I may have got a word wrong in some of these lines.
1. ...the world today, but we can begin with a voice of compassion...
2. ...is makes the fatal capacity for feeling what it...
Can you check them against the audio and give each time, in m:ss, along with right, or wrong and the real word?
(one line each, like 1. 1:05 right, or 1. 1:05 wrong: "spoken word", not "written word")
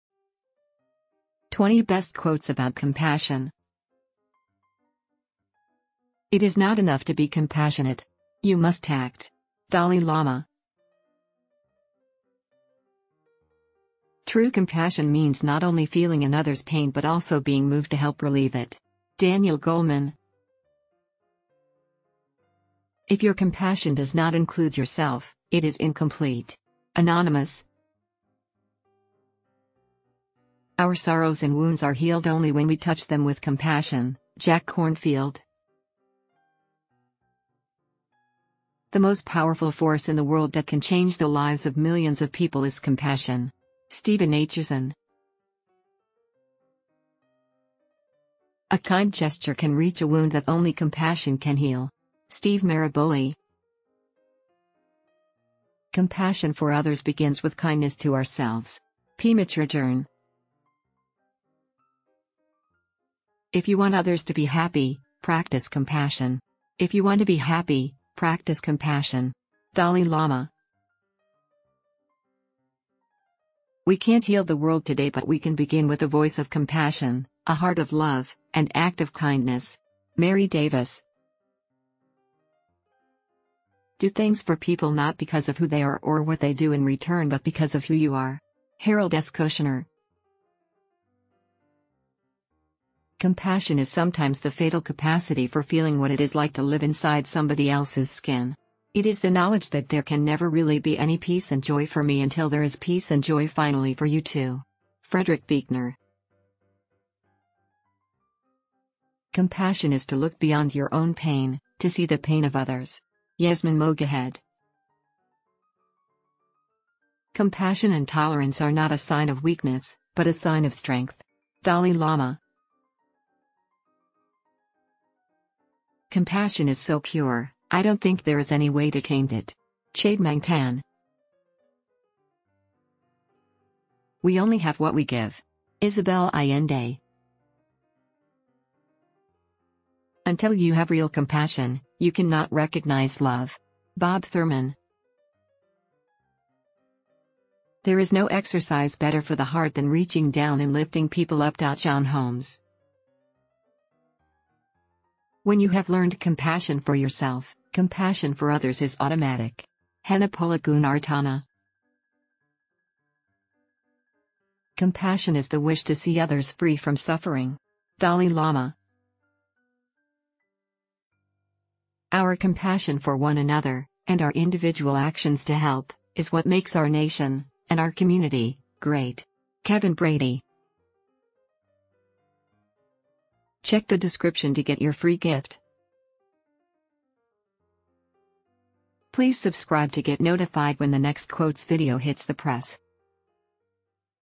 1. 1:14 right
2. 1:33 wrong: "sometimes", not "makes".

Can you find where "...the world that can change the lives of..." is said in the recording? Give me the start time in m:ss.
0:40.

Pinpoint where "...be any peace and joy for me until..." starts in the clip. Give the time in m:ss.
1:40.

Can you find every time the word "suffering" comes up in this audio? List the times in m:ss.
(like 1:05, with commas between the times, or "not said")
2:46.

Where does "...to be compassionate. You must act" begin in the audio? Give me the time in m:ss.
0:07.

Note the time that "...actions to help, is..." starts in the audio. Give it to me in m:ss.
2:54.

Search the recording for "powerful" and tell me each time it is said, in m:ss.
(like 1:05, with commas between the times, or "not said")
0:39.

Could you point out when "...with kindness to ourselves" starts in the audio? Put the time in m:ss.
0:57.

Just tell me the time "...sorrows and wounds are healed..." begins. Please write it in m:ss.
0:30.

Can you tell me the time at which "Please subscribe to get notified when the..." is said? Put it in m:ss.
3:09.